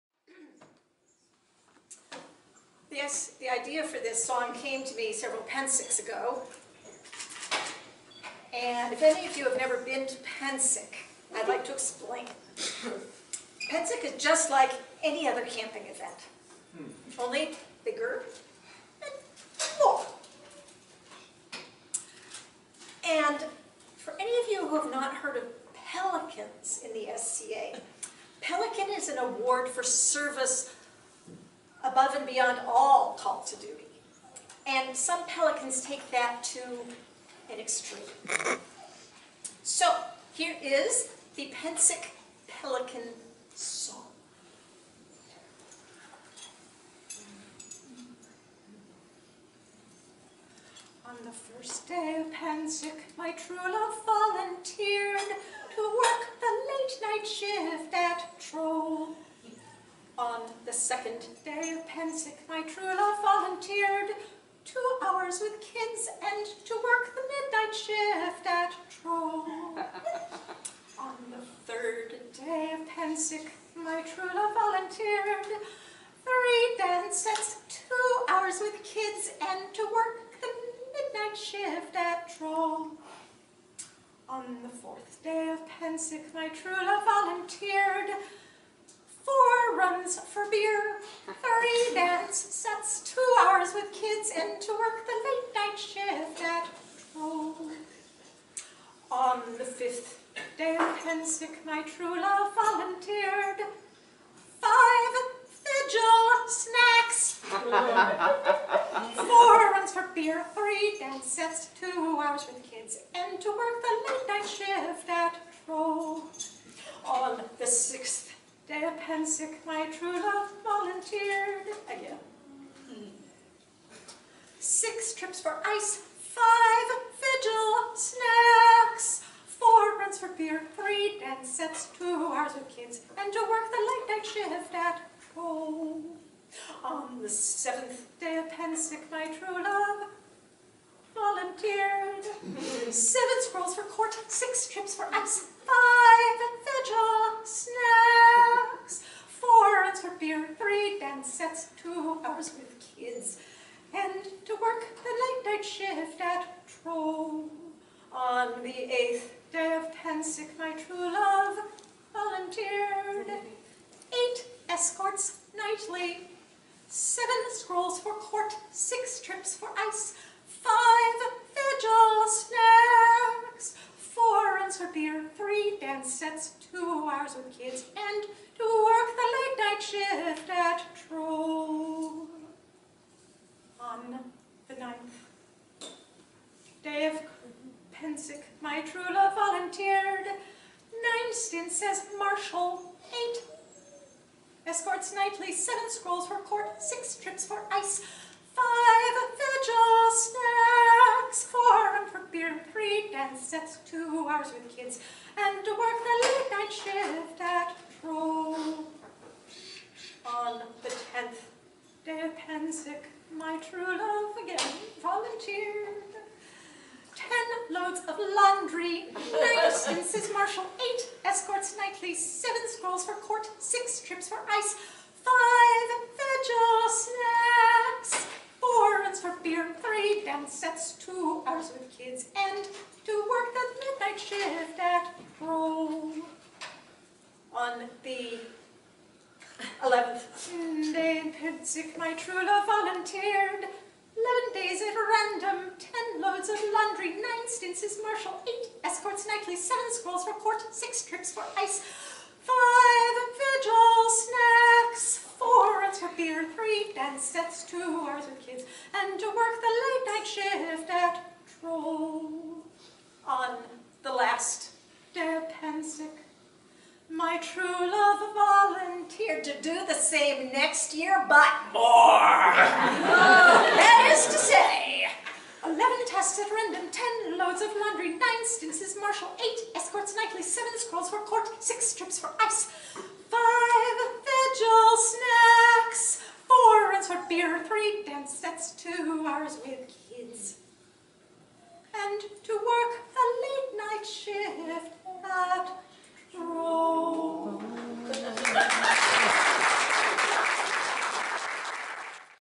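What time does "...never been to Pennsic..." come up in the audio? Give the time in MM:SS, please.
00:09.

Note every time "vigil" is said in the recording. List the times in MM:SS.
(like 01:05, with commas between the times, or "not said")
01:45, 02:07, 02:26, 02:51, 03:19, 03:46, 04:13, 04:44.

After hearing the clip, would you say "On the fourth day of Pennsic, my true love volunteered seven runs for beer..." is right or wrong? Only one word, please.
wrong.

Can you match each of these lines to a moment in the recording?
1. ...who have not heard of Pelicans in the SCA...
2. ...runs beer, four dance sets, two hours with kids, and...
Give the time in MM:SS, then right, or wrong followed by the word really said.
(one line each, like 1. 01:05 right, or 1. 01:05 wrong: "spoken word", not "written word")
1. 00:24 right
2. 02:54 wrong: "three", not "four".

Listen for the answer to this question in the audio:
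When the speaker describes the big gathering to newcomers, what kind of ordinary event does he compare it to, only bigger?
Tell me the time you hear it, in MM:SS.
00:15.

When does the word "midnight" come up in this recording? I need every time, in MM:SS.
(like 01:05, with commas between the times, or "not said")
01:07, 01:20, 03:53.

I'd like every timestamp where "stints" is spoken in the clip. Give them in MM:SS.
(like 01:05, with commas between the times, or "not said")
03:11, 04:07.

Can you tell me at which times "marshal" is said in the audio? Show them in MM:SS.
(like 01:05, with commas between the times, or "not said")
03:12, 03:40, 04:08, 04:39.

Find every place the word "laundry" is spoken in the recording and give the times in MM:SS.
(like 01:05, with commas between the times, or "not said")
03:38, 04:06, 04:37.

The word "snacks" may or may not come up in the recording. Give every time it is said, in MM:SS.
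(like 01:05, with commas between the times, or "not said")
01:46, 02:07, 02:27, 02:52, 03:20, 03:48, 04:14, 04:44.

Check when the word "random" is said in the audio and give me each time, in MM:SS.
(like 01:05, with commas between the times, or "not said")
04:04, 04:36.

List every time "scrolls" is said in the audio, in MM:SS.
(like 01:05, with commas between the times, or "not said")
02:23, 02:47, 03:15, 03:42, 04:09, 04:40.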